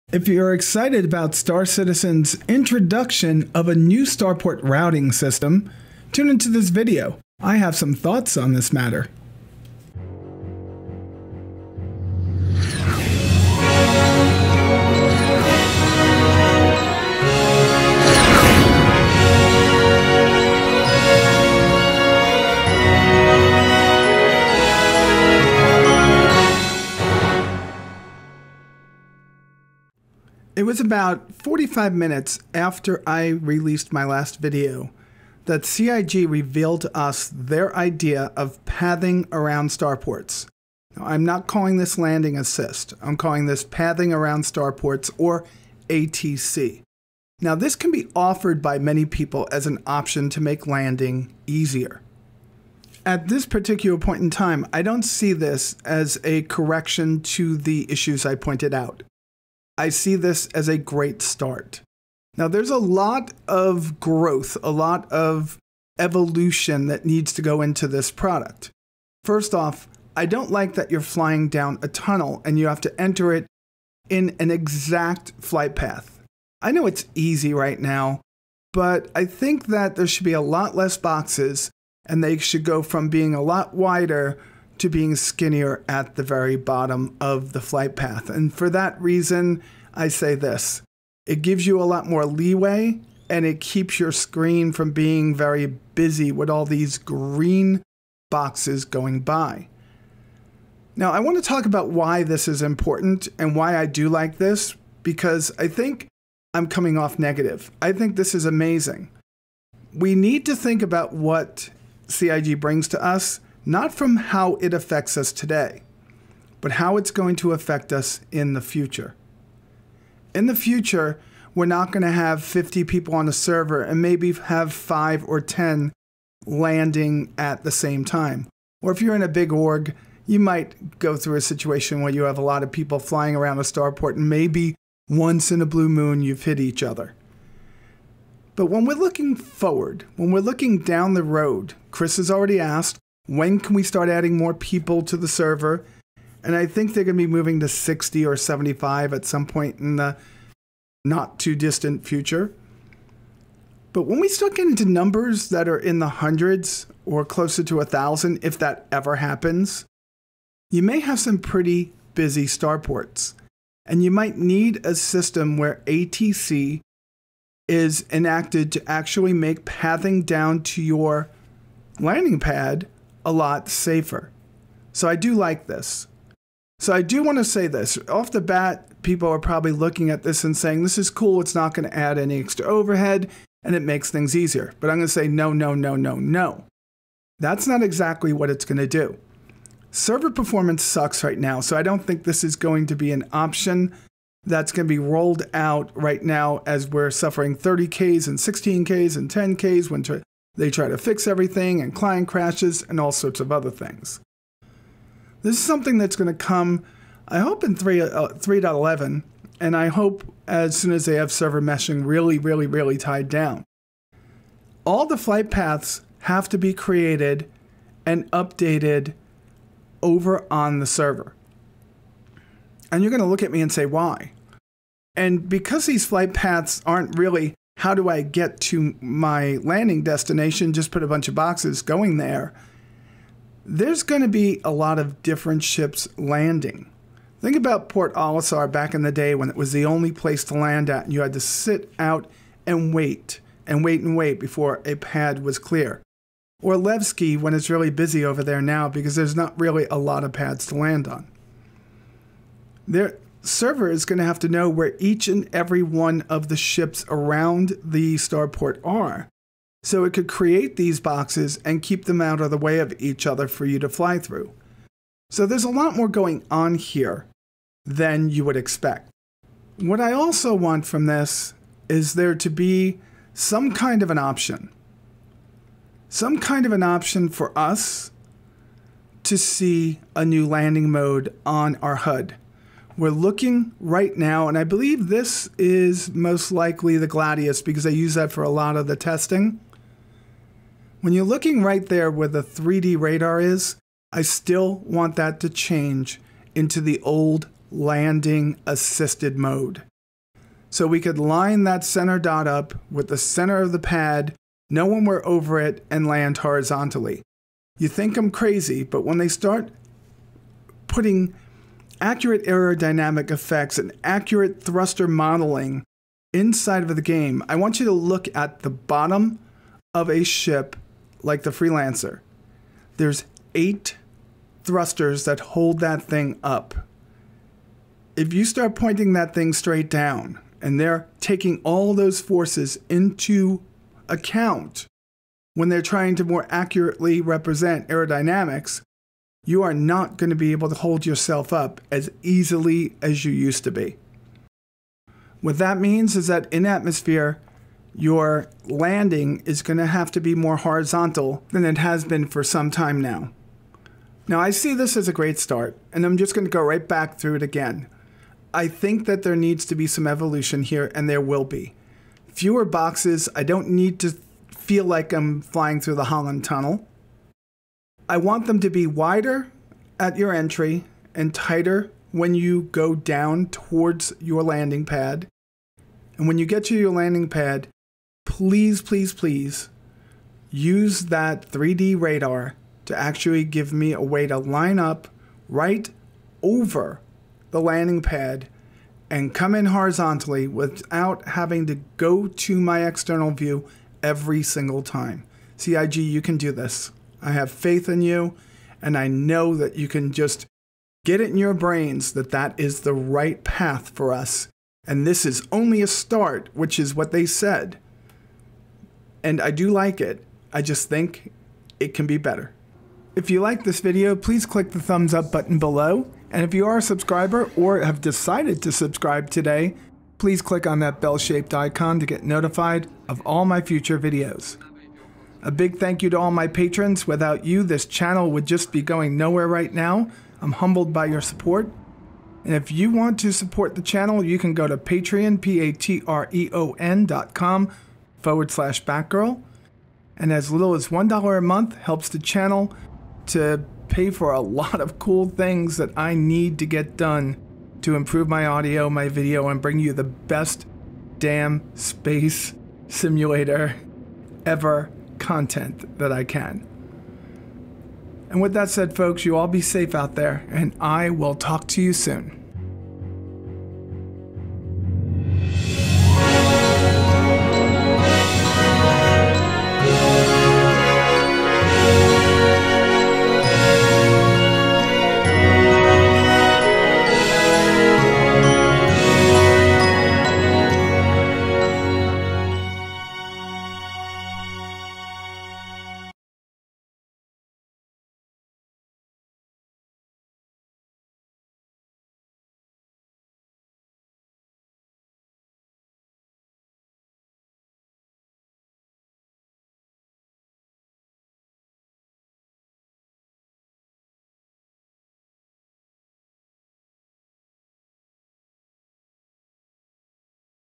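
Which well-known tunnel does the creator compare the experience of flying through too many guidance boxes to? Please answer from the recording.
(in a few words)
Holland Tunnel.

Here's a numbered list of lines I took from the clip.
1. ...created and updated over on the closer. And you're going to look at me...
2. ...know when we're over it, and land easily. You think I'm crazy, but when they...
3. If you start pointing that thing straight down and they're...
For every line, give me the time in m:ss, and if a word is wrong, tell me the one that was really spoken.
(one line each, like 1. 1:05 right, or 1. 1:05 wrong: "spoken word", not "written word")
1. 3:36 wrong: "server", not "closer"
2. 5:04 wrong: "horizontally", not "easily"
3. 5:28 right.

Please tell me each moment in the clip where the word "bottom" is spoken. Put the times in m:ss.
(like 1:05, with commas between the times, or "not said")
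1:26, 5:18.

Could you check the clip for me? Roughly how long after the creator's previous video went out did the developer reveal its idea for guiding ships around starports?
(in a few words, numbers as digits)
45 minutes.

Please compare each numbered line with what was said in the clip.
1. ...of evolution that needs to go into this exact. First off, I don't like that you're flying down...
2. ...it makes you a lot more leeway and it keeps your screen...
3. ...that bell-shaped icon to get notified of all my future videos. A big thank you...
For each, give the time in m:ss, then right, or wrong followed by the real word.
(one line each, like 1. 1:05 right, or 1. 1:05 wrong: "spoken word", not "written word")
1. 1:05 wrong: "product", not "exact"
2. 1:31 wrong: "gives", not "makes"
3. 7:00 right.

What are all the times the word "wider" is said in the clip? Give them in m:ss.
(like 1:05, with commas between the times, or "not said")
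1:23, 6:08.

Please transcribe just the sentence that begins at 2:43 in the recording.
And you might need a system where ATC is enacted to actually make pathing down to your landing pad a lot safer.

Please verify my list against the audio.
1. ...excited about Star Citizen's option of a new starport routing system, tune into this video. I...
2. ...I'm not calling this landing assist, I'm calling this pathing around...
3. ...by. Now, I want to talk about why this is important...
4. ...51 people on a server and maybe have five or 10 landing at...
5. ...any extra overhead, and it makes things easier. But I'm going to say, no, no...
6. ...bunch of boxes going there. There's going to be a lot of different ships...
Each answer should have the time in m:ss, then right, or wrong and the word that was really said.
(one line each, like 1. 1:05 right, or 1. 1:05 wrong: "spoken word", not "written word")
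1. 0:00 wrong: "introduction", not "option"
2. 0:41 right
3. 1:39 right
4. 2:02 wrong: "50", not "51"
5. 3:02 right
6. 3:51 right.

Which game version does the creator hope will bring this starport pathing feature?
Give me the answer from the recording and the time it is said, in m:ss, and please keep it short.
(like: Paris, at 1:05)
3.11, at 3:28.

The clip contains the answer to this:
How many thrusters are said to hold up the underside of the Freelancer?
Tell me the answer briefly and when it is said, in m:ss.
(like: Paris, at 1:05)
8, at 5:23.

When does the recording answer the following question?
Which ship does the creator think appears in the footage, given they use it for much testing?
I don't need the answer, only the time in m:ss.
4:47.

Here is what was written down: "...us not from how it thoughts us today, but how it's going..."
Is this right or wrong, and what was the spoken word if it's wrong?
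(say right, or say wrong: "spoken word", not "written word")
wrong: "affects", not "thoughts".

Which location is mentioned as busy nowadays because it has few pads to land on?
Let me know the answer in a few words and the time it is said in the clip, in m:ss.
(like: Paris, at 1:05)
Levski, at 4:06.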